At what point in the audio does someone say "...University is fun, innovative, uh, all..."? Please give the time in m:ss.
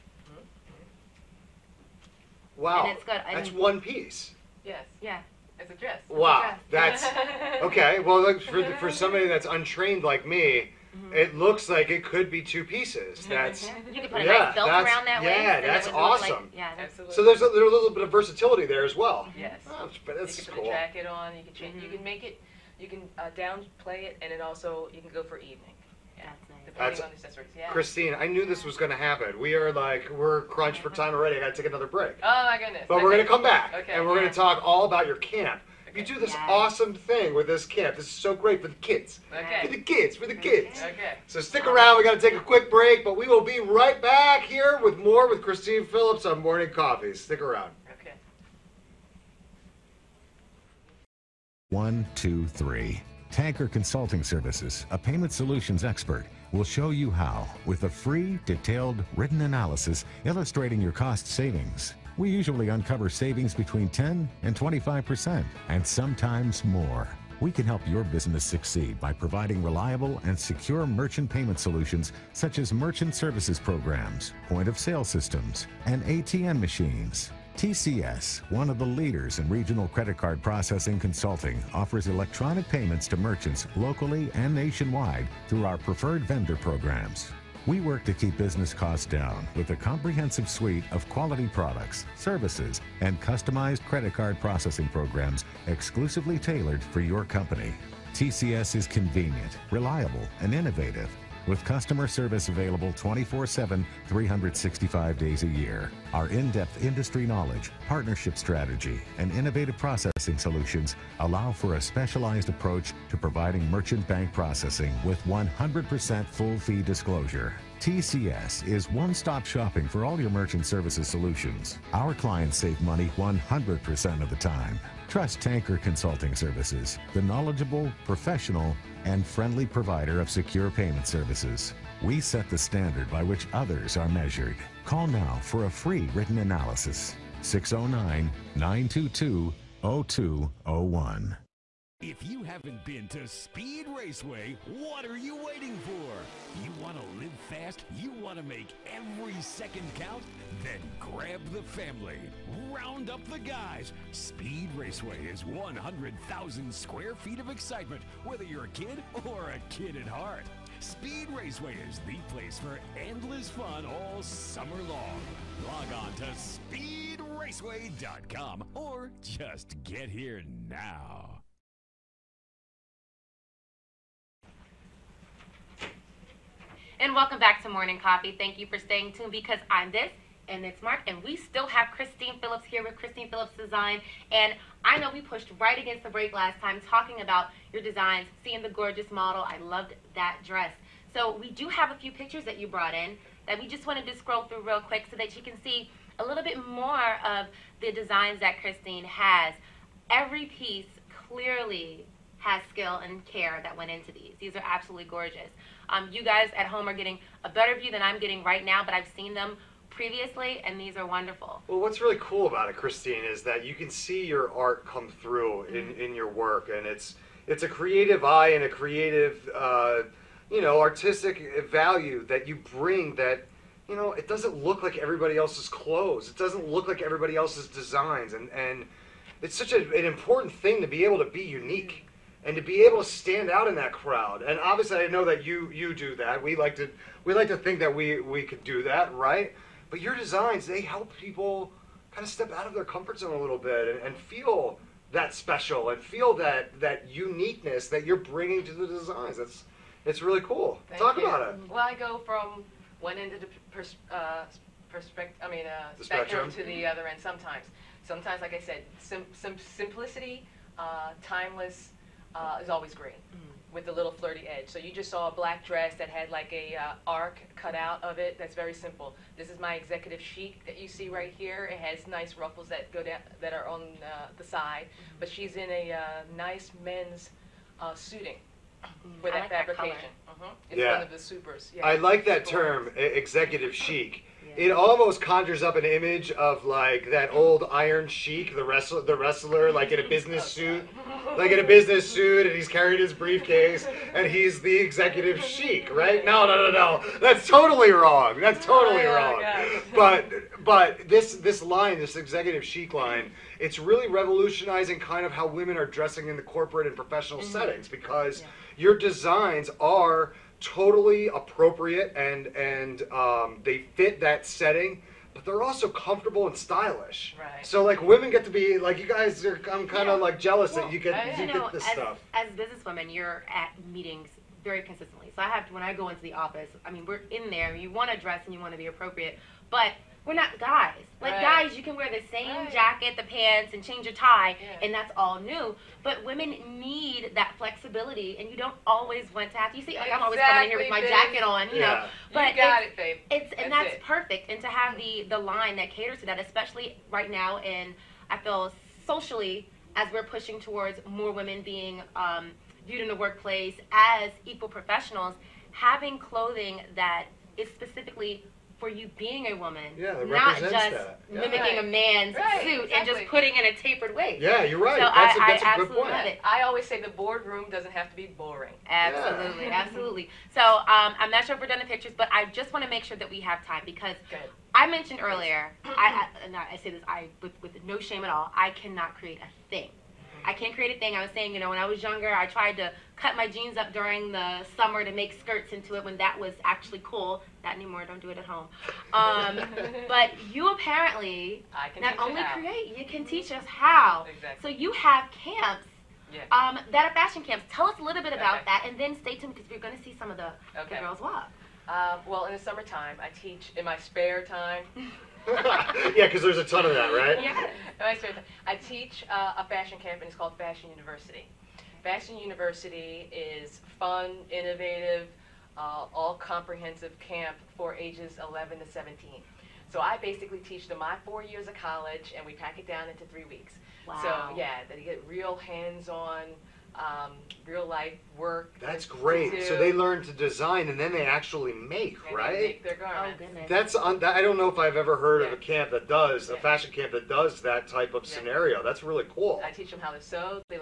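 6:52.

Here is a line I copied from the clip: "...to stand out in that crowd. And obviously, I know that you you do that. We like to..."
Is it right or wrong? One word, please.
right.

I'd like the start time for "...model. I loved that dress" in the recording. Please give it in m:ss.
3:09.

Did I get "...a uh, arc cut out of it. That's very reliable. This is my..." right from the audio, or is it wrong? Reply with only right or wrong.
wrong.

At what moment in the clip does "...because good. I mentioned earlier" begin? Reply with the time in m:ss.
6:13.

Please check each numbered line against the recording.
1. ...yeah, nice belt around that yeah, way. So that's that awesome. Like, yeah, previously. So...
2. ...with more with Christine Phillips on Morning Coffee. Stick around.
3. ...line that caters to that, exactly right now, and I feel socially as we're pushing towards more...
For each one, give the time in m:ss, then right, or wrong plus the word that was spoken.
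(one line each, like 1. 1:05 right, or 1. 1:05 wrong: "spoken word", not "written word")
1. 0:14 wrong: "absolutely", not "previously"
2. 0:44 right
3. 5:45 wrong: "especially", not "exactly".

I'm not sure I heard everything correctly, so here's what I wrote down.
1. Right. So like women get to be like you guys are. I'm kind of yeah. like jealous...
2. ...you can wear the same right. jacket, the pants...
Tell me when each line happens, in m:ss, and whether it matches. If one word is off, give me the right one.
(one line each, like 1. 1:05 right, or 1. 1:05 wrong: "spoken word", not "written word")
1. 5:17 right
2. 5:31 right.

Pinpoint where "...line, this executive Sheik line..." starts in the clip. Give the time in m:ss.
5:01.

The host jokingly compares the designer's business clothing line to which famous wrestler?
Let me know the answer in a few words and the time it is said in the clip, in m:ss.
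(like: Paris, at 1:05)
Iron Sheik, at 4:47.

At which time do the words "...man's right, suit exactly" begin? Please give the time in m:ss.
6:01.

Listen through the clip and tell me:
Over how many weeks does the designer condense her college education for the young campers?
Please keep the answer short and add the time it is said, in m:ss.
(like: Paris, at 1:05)
3 weeks, at 7:03.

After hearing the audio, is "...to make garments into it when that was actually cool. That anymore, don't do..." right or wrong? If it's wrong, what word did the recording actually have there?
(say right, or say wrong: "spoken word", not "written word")
wrong: "skirts", not "garments".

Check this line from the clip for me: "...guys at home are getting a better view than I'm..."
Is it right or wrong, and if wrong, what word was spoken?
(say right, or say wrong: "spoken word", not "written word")
right.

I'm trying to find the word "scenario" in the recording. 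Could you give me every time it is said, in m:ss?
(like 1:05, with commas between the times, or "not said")
7:18.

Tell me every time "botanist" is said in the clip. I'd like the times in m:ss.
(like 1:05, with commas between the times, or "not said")
not said.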